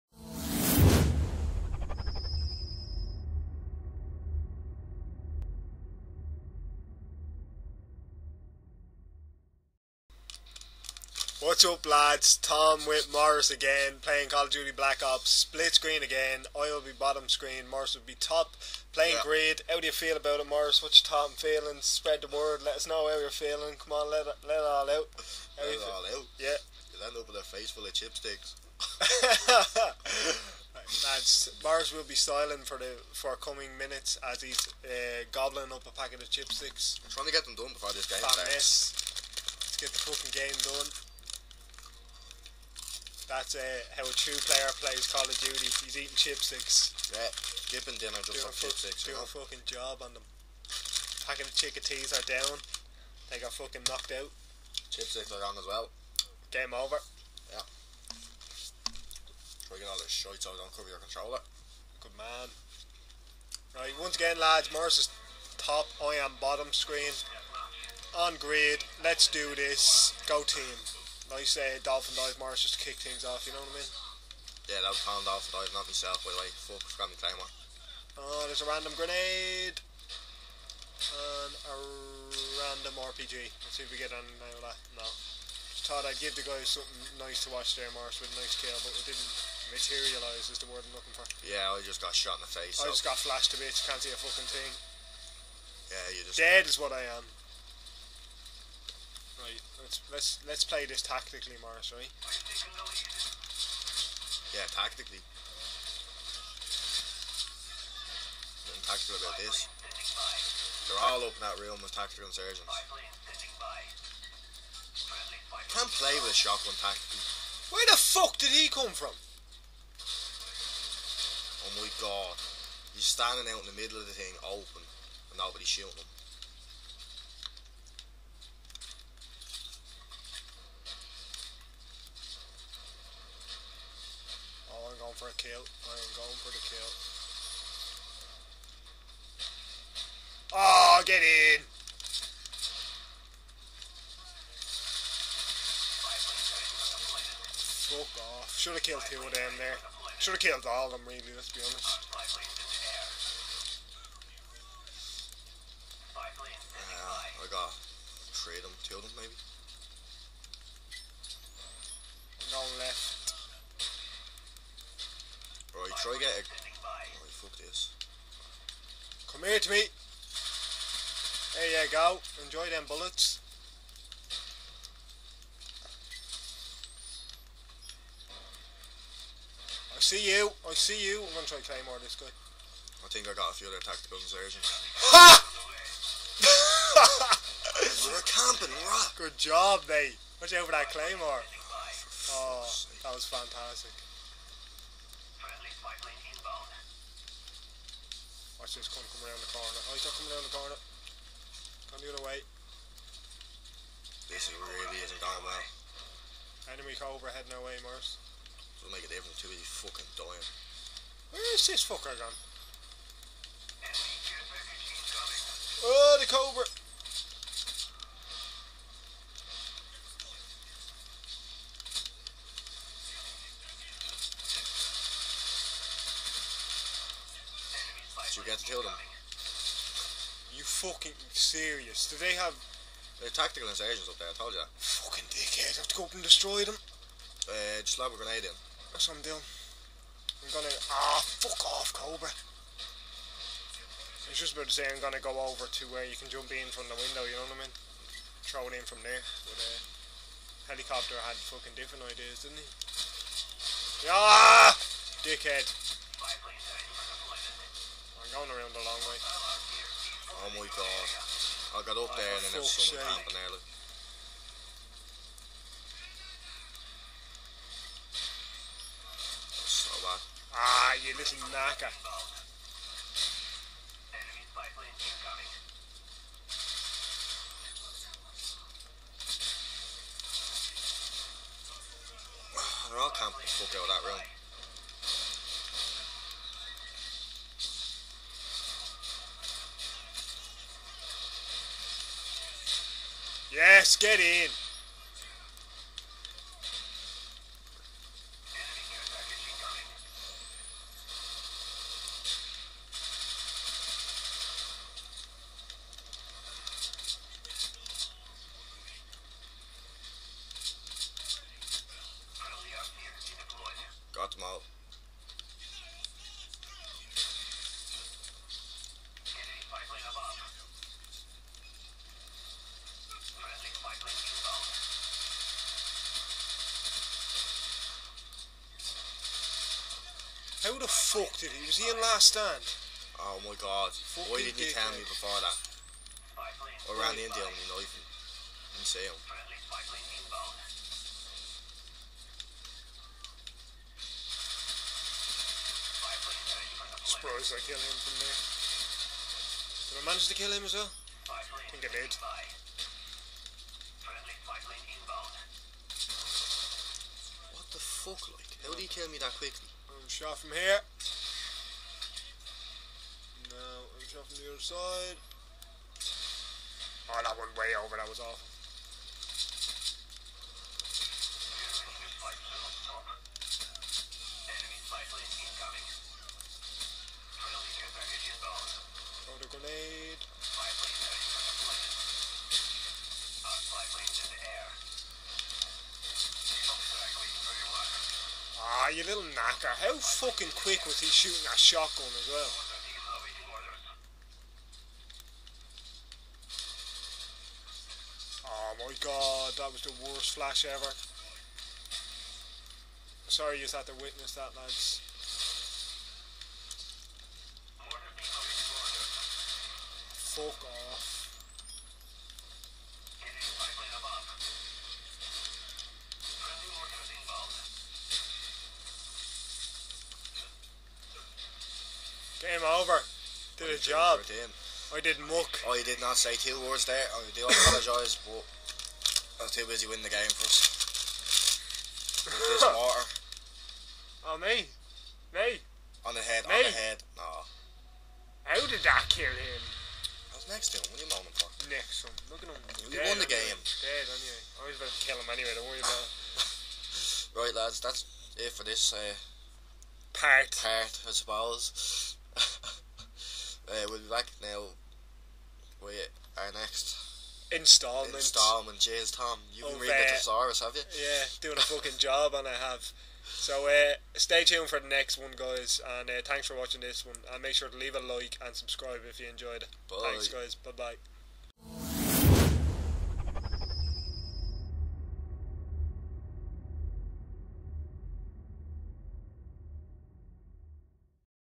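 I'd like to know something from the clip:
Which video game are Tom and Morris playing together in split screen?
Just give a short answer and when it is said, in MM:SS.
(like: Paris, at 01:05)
Call of Duty Black Ops, at 00:14.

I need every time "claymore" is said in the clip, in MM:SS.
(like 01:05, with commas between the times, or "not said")
01:17, 03:01, 03:10.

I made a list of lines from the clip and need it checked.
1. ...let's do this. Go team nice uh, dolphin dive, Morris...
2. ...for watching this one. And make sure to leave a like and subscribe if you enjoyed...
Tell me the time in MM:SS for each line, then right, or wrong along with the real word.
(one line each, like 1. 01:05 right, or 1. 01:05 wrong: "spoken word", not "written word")
1. 01:09 right
2. 07:46 right.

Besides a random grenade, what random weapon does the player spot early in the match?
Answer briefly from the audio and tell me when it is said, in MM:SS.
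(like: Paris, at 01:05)
RPG, at 01:21.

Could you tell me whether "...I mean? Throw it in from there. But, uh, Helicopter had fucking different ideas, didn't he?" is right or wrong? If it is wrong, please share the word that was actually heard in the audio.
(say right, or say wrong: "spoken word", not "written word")
right.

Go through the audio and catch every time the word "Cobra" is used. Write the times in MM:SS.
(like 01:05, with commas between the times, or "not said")
03:26, 03:36, 04:01.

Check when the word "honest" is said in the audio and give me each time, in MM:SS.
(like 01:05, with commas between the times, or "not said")
02:31.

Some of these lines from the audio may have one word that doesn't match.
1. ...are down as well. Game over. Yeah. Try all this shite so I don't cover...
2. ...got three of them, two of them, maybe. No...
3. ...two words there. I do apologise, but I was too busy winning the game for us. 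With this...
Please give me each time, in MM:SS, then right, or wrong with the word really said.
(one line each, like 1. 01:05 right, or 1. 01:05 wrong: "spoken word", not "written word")
1. 00:55 right
2. 02:37 right
3. 07:06 right.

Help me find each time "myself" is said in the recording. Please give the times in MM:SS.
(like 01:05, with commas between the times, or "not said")
01:15.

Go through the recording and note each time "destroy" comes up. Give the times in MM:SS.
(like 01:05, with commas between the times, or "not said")
03:56.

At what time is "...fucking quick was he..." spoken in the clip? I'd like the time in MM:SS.
06:29.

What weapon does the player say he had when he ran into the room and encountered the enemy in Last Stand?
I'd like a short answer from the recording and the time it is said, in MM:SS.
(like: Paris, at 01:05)
Knife, at 05:37.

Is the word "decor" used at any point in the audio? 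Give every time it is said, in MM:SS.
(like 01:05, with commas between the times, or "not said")
not said.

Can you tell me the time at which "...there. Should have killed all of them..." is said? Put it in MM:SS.
02:29.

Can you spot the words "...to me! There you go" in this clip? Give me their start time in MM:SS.
02:49.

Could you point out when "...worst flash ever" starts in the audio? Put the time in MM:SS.
06:40.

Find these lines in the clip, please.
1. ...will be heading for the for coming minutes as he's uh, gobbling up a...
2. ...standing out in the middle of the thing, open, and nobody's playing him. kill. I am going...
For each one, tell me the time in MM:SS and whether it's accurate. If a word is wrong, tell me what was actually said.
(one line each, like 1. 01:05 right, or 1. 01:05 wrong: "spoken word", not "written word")
1. 00:31 wrong: "styling", not "heading"
2. 02:03 wrong: "shooting", not "playing".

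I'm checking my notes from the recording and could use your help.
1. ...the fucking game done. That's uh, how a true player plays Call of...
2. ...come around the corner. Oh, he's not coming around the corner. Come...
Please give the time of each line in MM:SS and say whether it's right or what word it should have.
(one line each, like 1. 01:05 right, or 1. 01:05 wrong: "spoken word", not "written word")
1. 00:39 right
2. 03:19 right.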